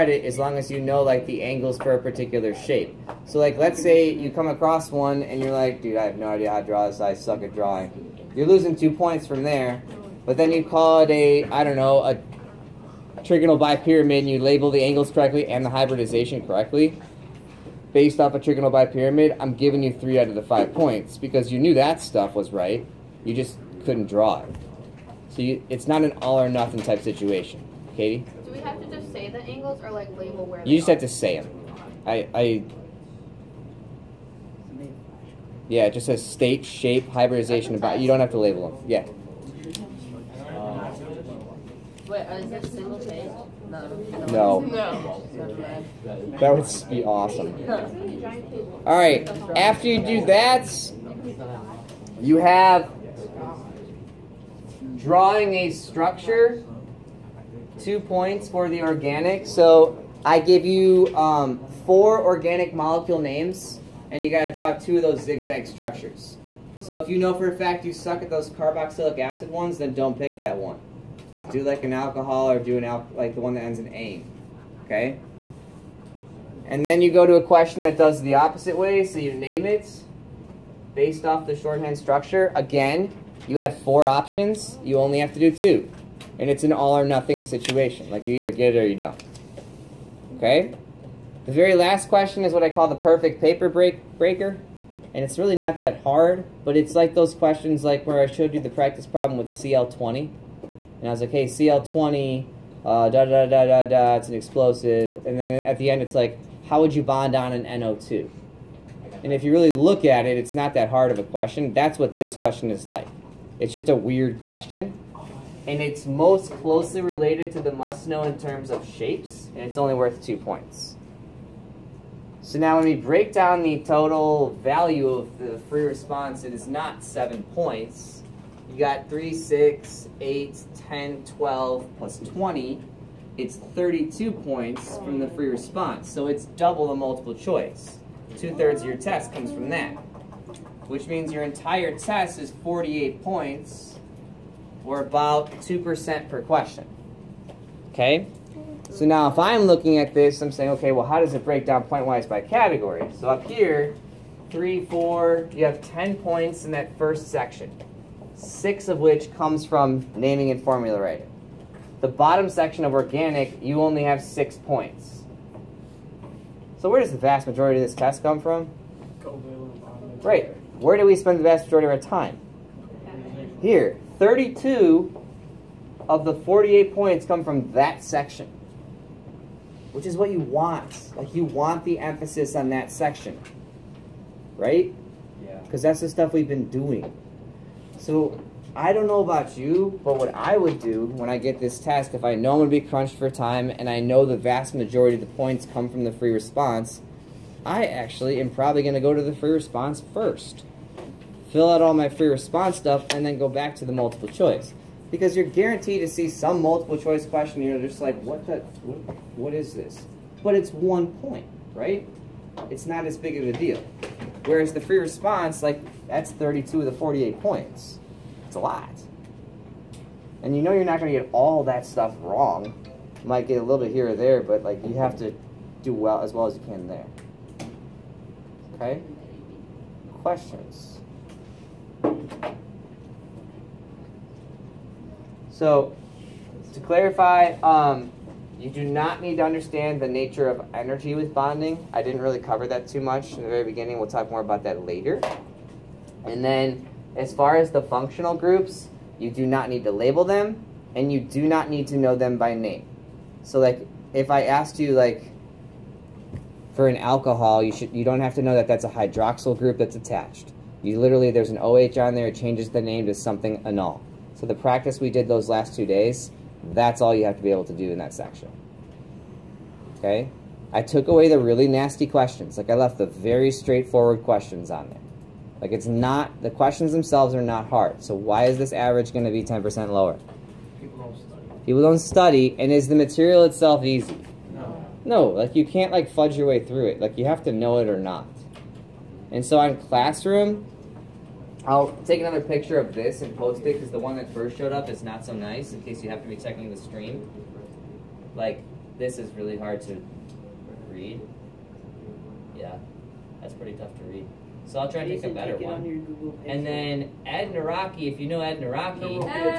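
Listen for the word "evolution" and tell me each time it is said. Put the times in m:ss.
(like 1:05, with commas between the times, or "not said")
not said.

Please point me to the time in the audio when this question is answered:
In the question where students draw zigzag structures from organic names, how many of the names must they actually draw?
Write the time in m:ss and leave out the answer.
1:04.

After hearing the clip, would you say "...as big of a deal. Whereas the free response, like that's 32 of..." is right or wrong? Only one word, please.
right.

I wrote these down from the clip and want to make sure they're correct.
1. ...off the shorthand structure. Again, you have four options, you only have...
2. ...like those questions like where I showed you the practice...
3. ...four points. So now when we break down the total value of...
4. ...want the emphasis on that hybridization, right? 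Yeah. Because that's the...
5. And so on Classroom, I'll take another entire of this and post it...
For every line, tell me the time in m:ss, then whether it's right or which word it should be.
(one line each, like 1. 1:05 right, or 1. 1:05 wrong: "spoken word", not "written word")
1. 1:21 right
2. 1:36 right
3. 2:00 wrong: "two", not "four"
4. 3:01 wrong: "section", not "hybridization"
5. 4:49 wrong: "picture", not "entire".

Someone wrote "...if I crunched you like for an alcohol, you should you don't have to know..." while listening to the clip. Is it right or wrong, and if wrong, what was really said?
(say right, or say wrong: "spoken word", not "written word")
wrong: "asked", not "crunched".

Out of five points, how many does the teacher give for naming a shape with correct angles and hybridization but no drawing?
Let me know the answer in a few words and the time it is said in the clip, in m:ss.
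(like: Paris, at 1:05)
3, at 0:19.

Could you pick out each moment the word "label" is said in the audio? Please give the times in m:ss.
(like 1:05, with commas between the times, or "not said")
0:14, 0:30, 0:38, 4:09.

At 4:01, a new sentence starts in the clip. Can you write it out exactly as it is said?
I didn't really cover that too much in the very beginning.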